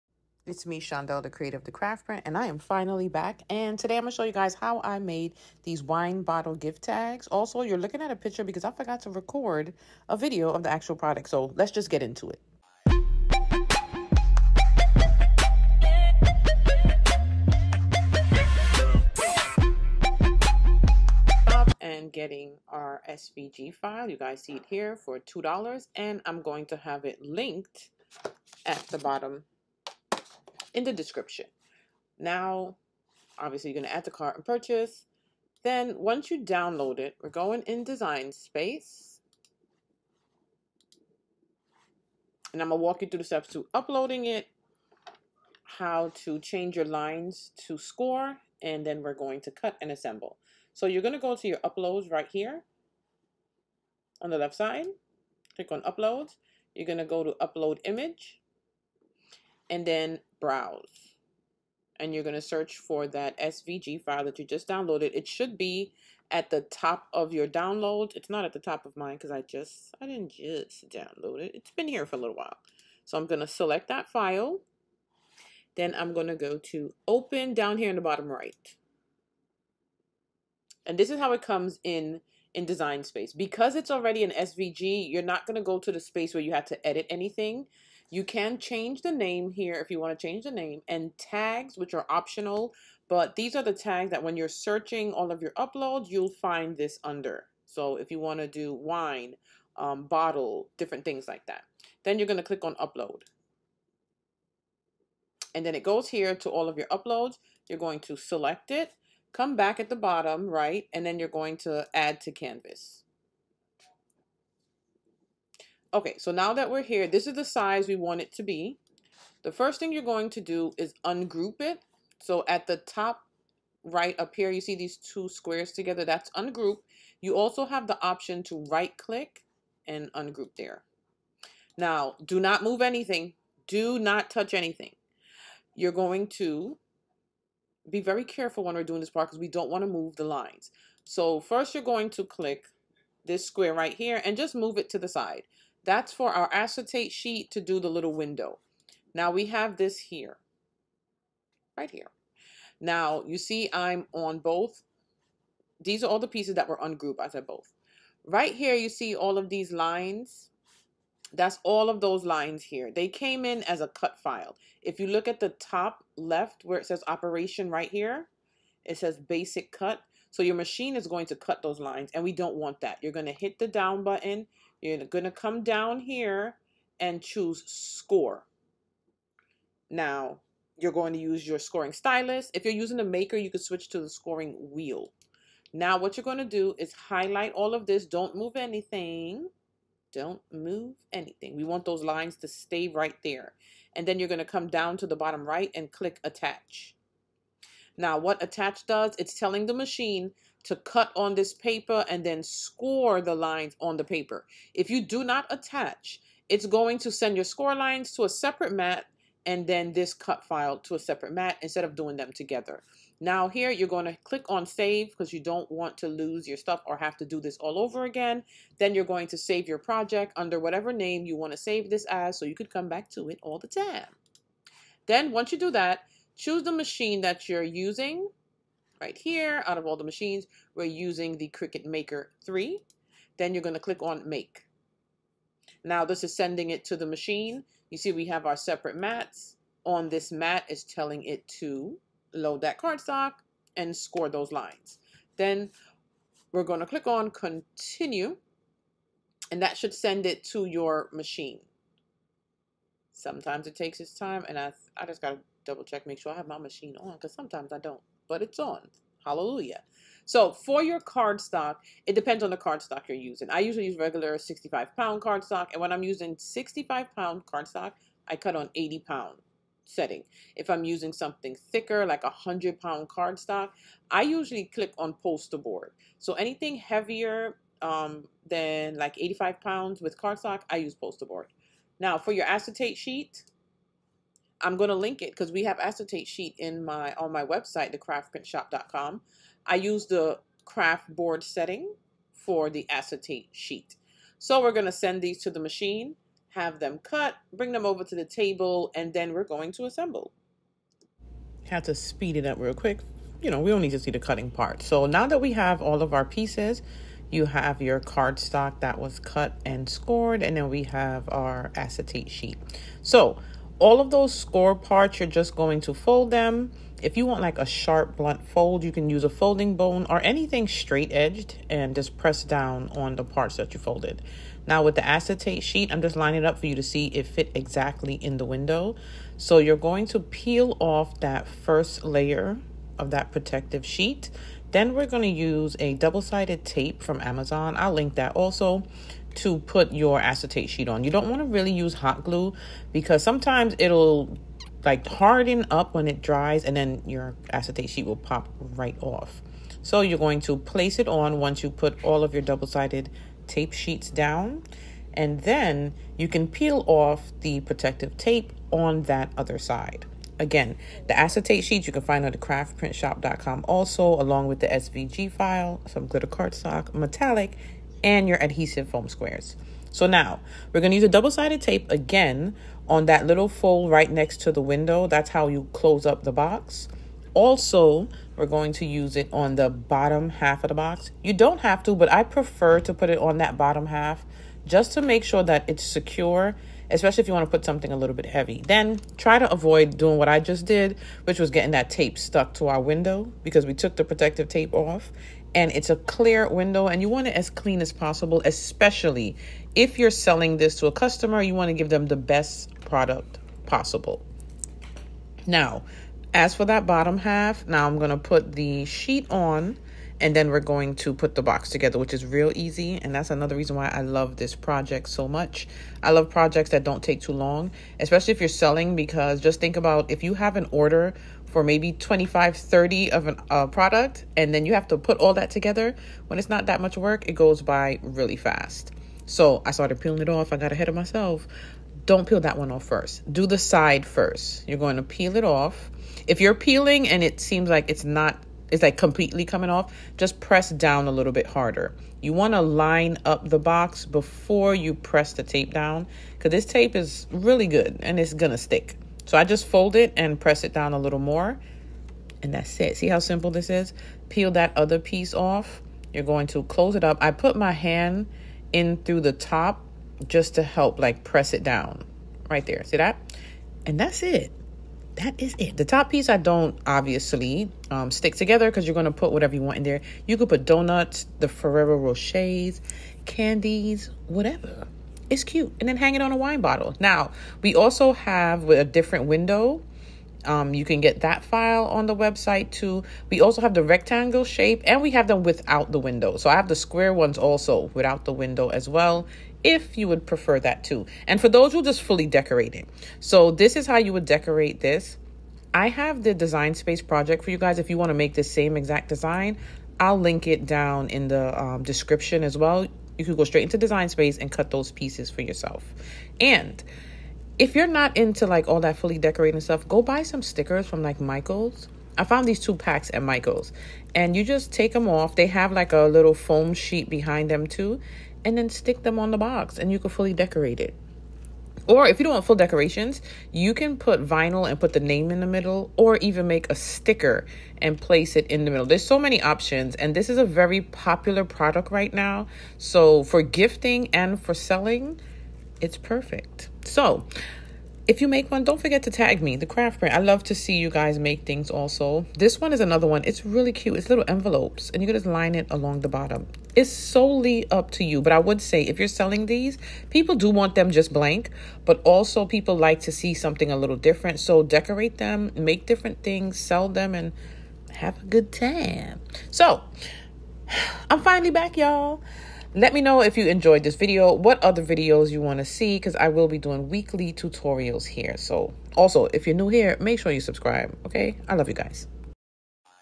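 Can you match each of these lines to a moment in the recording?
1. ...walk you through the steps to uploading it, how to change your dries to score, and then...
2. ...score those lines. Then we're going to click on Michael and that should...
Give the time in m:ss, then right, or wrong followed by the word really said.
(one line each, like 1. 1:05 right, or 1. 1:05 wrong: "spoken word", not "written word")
1. 0:42 wrong: "lines", not "dries"
2. 4:03 wrong: "Continue", not "Michael".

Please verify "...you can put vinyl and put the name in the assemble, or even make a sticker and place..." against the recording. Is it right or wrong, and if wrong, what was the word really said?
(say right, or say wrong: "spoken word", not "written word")
wrong: "middle", not "assemble".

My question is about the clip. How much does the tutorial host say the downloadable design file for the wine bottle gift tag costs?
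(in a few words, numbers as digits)
$2.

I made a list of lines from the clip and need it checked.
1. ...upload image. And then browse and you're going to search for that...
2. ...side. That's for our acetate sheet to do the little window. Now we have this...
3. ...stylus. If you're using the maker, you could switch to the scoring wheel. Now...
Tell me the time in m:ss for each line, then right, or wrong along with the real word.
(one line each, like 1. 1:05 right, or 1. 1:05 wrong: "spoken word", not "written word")
1. 0:57 right
2. 2:25 right
3. 3:01 right.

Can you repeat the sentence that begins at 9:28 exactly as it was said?
So also, if you're new here, make sure you subscribe, okay?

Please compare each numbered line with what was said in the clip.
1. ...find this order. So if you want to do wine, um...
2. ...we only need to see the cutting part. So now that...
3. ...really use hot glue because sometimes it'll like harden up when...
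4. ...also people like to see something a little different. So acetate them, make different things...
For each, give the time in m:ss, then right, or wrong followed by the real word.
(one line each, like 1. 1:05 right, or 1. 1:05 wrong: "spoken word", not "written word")
1. 1:36 wrong: "under", not "order"
2. 5:03 right
3. 5:41 right
4. 9:12 wrong: "decorate", not "acetate".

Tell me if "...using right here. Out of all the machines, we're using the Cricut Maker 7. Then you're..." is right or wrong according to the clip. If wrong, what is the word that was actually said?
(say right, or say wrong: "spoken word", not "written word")
wrong: "3", not "7".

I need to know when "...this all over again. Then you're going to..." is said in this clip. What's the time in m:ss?
3:37.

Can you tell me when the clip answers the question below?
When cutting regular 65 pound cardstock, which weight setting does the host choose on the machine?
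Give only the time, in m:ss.
4:28.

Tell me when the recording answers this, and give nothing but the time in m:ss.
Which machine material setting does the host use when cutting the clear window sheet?
4:50.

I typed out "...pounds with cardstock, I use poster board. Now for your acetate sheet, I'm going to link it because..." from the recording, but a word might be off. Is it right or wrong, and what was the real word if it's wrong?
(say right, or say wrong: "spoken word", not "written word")
right.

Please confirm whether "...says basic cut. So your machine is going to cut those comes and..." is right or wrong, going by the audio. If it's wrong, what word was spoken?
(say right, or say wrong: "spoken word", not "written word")
wrong: "lines", not "comes".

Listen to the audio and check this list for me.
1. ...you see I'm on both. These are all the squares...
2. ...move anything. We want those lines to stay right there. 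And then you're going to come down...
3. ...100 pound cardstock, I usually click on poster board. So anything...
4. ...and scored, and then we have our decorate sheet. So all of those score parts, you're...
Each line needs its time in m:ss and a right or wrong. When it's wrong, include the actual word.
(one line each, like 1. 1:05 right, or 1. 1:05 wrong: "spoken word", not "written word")
1. 2:33 wrong: "pieces", not "squares"
2. 3:10 right
3. 4:32 right
4. 5:09 wrong: "acetate", not "decorate".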